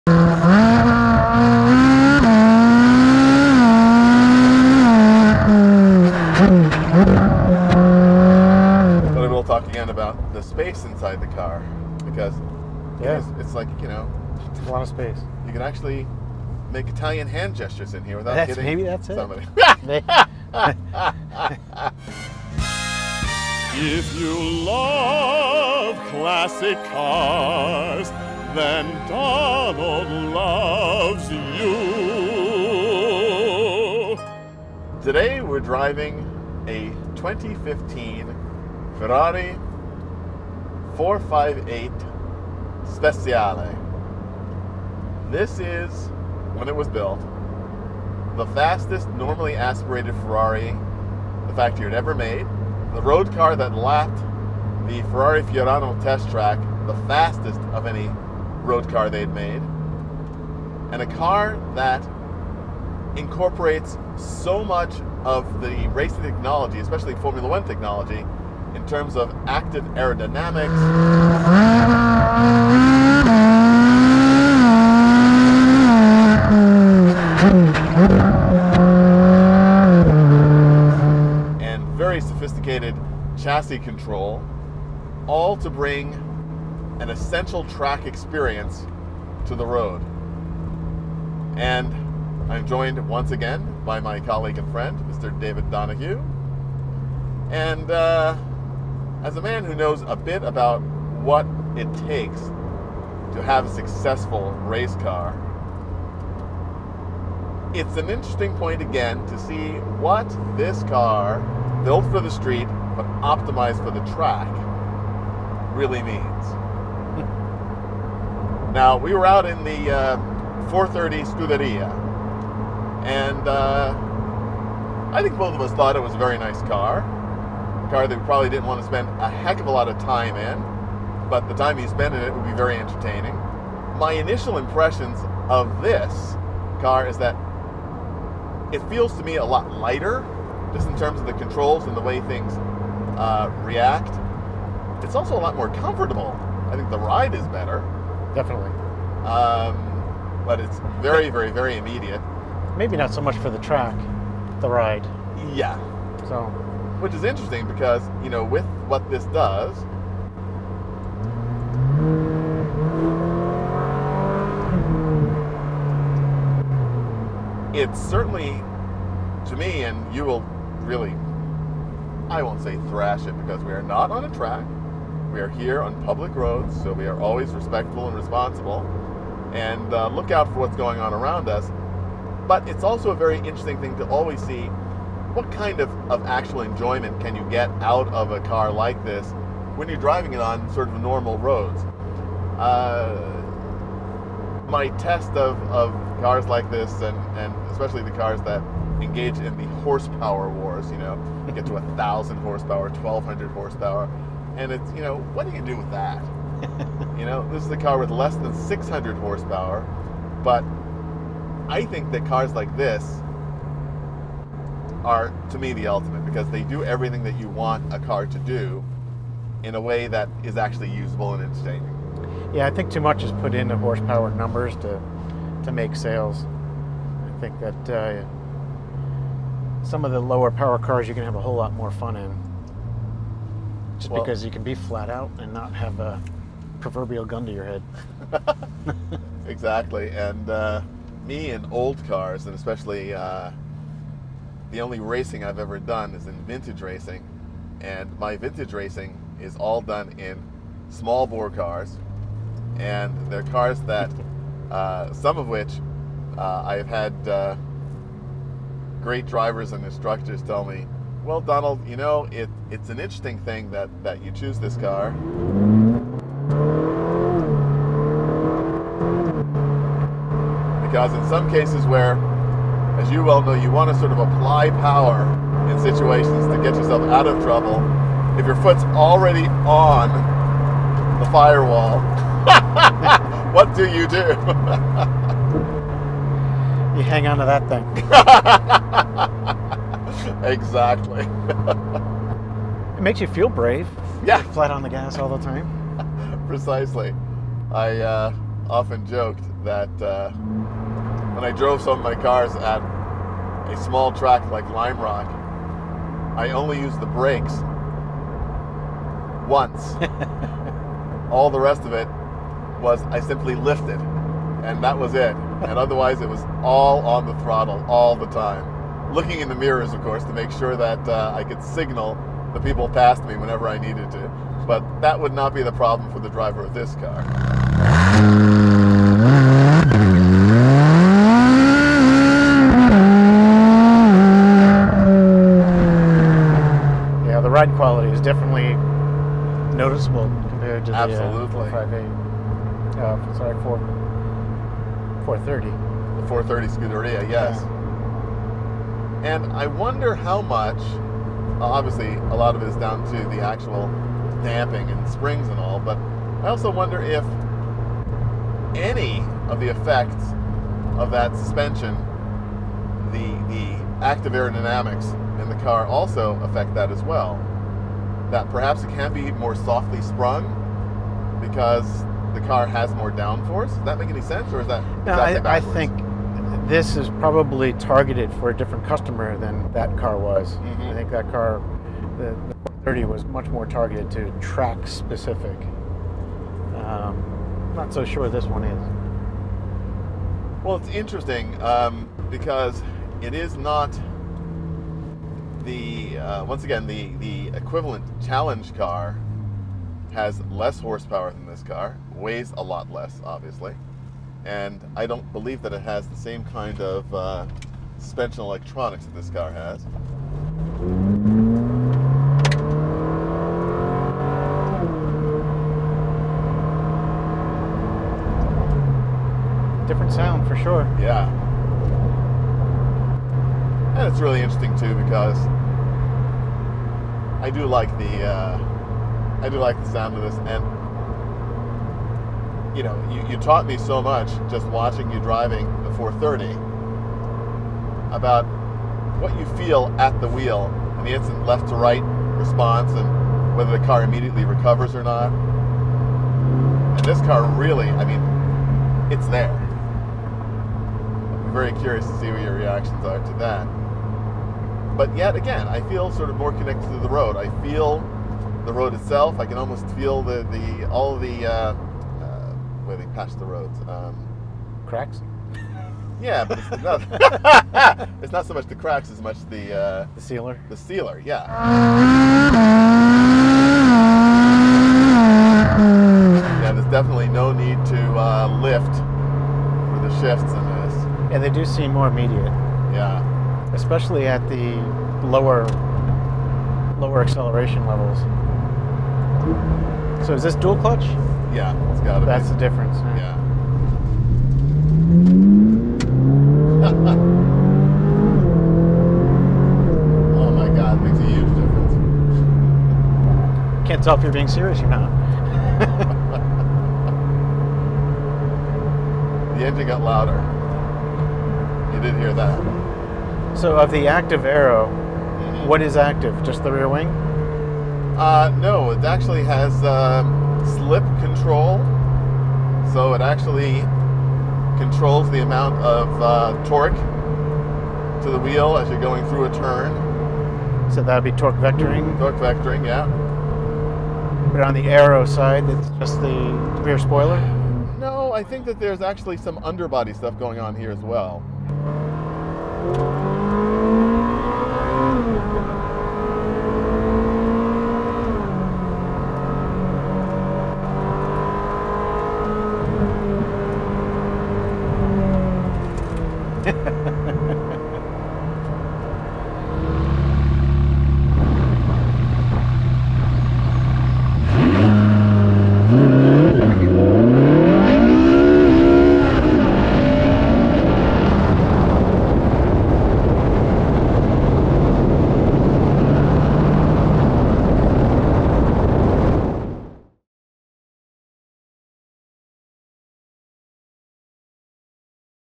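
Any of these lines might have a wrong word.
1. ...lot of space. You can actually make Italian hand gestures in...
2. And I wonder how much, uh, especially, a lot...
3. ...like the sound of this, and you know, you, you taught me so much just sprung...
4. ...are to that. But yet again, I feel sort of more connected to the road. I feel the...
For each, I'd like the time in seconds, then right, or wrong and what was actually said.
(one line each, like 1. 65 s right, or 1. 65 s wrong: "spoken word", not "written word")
1. 14 s right
2. 349 s wrong: "obviously", not "especially"
3. 429 s wrong: "watching", not "sprung"
4. 453 s right.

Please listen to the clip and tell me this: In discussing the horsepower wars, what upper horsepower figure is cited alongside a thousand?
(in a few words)
1200.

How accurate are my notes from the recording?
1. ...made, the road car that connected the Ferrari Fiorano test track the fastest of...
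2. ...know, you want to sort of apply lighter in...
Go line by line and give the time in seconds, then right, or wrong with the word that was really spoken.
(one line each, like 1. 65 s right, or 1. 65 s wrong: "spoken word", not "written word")
1. 52 s wrong: "lapped", not "connected"
2. 273 s wrong: "power", not "lighter".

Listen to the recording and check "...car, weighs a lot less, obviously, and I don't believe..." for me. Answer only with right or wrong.
right.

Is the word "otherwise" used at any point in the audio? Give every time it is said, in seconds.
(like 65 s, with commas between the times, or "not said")
315 s.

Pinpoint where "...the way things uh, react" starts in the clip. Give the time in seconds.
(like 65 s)
141 s.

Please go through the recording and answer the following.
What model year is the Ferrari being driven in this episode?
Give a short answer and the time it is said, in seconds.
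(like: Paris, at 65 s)
2015, at 37 s.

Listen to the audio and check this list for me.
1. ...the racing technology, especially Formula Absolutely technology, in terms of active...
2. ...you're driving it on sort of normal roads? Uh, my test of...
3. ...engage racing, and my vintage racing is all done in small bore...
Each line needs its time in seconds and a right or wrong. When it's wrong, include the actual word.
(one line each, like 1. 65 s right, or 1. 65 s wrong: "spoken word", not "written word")
1. 65 s wrong: "One", not "Absolutely"
2. 189 s right
3. 246 s wrong: "vintage", not "engage".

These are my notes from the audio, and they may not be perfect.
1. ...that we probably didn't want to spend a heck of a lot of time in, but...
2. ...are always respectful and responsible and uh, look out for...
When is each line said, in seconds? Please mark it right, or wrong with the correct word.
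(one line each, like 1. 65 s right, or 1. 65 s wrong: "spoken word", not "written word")
1. 128 s right
2. 177 s right.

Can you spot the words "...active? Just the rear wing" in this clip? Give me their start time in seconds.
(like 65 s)
515 s.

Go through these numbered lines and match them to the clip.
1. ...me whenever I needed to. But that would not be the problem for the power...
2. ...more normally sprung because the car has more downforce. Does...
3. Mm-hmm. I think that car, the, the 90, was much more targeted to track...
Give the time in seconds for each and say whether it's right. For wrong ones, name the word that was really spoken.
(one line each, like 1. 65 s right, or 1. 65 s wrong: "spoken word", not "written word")
1. 323 s wrong: "driver", not "power"
2. 369 s wrong: "softly", not "normally"
3. 380 s wrong: "30", not "90".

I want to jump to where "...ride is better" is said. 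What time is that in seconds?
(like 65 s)
146 s.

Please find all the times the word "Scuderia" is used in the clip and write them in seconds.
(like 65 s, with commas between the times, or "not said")
121 s, 346 s.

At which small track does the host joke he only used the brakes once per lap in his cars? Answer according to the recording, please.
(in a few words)
Lime Rock.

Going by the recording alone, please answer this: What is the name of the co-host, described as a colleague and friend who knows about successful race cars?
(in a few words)
David Donohue.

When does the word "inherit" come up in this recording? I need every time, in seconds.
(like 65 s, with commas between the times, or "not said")
not said.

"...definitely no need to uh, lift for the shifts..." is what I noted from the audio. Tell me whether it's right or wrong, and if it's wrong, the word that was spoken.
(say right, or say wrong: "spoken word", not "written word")
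right.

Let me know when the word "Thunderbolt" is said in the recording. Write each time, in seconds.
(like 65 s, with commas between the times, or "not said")
not said.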